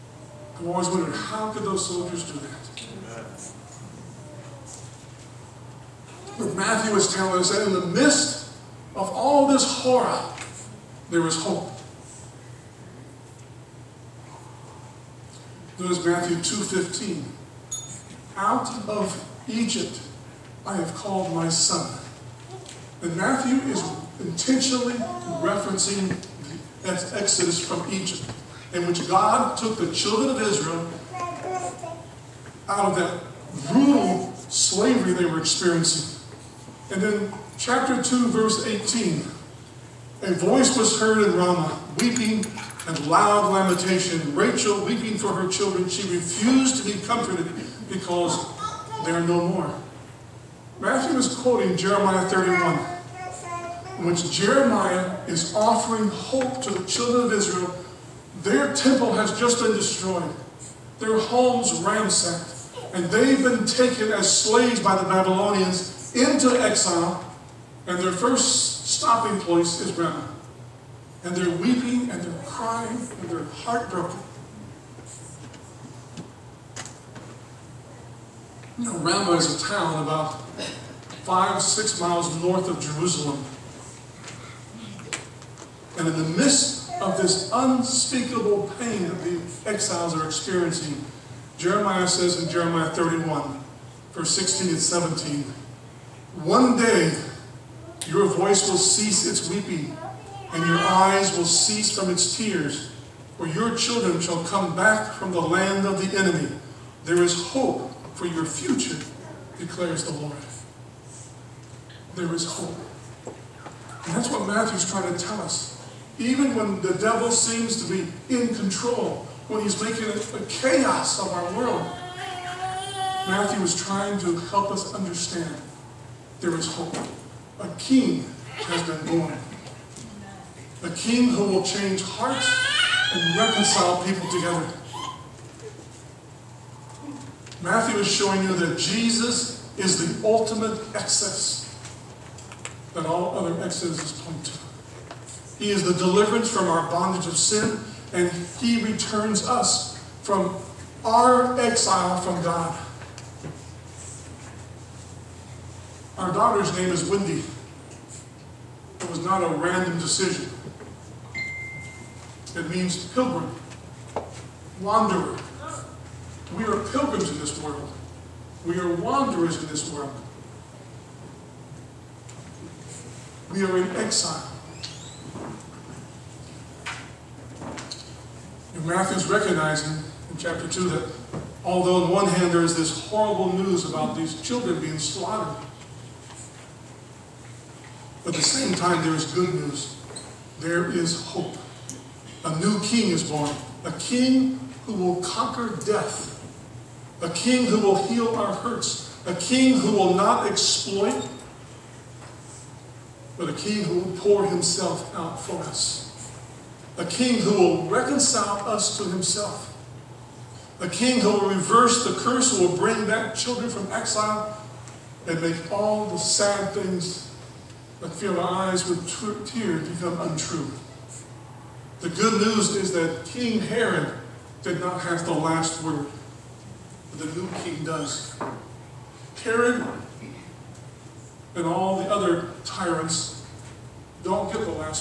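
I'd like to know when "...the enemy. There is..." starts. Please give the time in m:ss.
1:46.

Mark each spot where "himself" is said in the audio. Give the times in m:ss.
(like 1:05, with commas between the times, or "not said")
3:24, 3:29.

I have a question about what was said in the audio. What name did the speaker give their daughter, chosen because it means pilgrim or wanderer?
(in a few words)
Wendy.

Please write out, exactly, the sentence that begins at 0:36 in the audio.
And then chapter 2, verse 18, a voice was heard in Ramah, weeping and loud lamentation.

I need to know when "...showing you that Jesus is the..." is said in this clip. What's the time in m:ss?
2:18.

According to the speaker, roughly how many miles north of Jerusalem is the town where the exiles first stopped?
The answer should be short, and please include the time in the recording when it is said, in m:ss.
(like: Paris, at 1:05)
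5-6 miles, at 1:21.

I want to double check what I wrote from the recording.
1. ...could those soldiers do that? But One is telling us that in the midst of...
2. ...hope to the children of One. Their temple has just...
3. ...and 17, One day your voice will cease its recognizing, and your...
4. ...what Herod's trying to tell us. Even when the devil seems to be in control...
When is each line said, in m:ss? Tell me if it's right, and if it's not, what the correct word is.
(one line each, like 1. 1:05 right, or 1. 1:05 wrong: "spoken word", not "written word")
1. 0:01 wrong: "Matthew", not "One"
2. 0:56 wrong: "Israel", not "One"
3. 1:34 wrong: "weeping", not "recognizing"
4. 1:54 wrong: "Matthew", not "Herod".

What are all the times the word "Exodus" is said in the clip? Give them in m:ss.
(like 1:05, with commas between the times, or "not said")
0:27.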